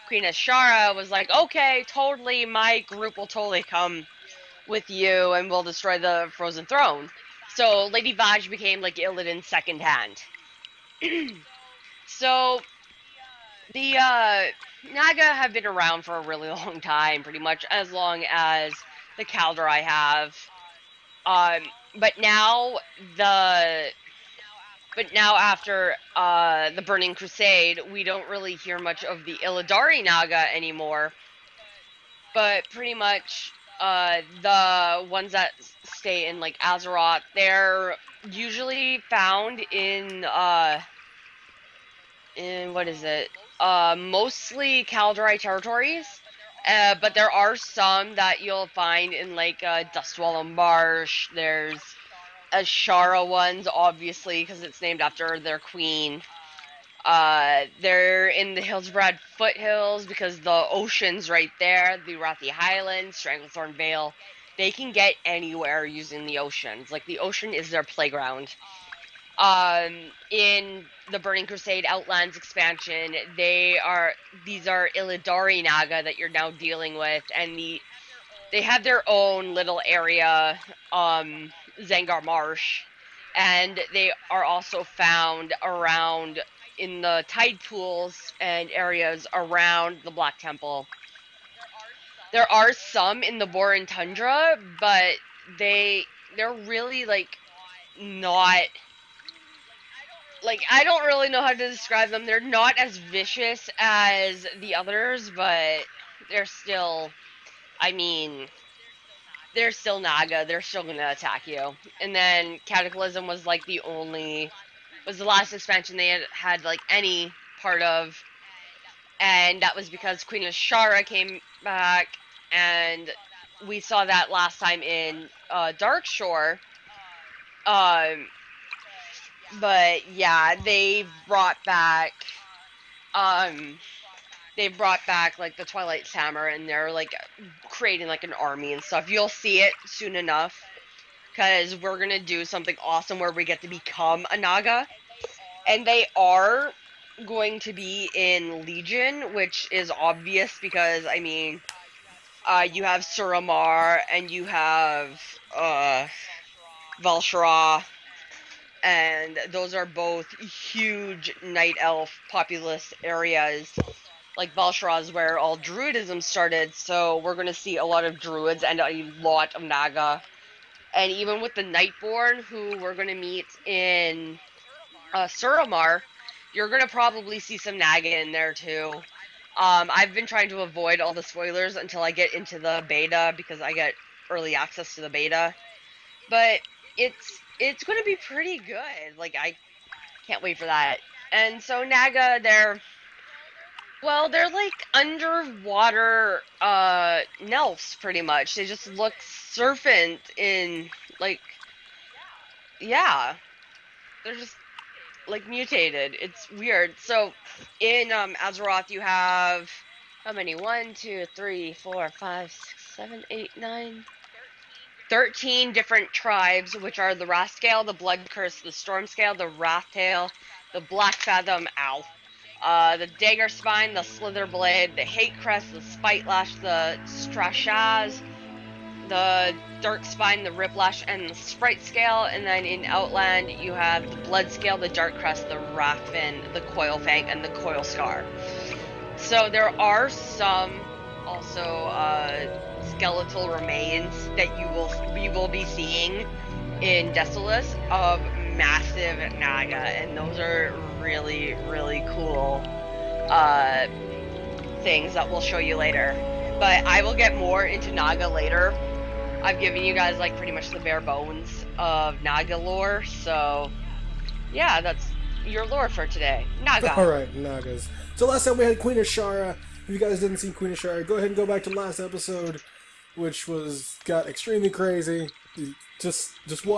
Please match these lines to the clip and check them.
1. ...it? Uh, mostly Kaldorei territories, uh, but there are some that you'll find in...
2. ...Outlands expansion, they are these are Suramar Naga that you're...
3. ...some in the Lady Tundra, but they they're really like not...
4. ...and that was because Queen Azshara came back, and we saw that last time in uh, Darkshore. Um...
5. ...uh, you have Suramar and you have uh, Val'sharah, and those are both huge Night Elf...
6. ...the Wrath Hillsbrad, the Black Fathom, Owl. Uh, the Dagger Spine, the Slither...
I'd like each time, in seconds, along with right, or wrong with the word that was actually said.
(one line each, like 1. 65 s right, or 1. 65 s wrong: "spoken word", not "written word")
1. 43 s right
2. 71 s wrong: "Illidari", not "Suramar"
3. 92 s wrong: "Borean", not "Lady"
4. 119 s right
5. 152 s right
6. 219 s wrong: "Tail", not "Hillsbrad".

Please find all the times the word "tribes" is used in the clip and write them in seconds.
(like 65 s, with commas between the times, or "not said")
216 s.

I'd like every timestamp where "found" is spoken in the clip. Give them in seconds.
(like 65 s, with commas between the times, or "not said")
39 s, 84 s.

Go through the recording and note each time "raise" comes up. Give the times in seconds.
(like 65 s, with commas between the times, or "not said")
not said.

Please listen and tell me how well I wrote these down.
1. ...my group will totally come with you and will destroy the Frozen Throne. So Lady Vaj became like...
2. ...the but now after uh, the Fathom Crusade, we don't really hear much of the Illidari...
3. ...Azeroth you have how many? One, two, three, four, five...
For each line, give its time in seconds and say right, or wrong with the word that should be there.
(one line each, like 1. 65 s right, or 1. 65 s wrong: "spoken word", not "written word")
1. 2 s right
2. 23 s wrong: "Burning", not "Fathom"
3. 208 s right.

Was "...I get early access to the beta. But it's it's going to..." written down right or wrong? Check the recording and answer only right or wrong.
right.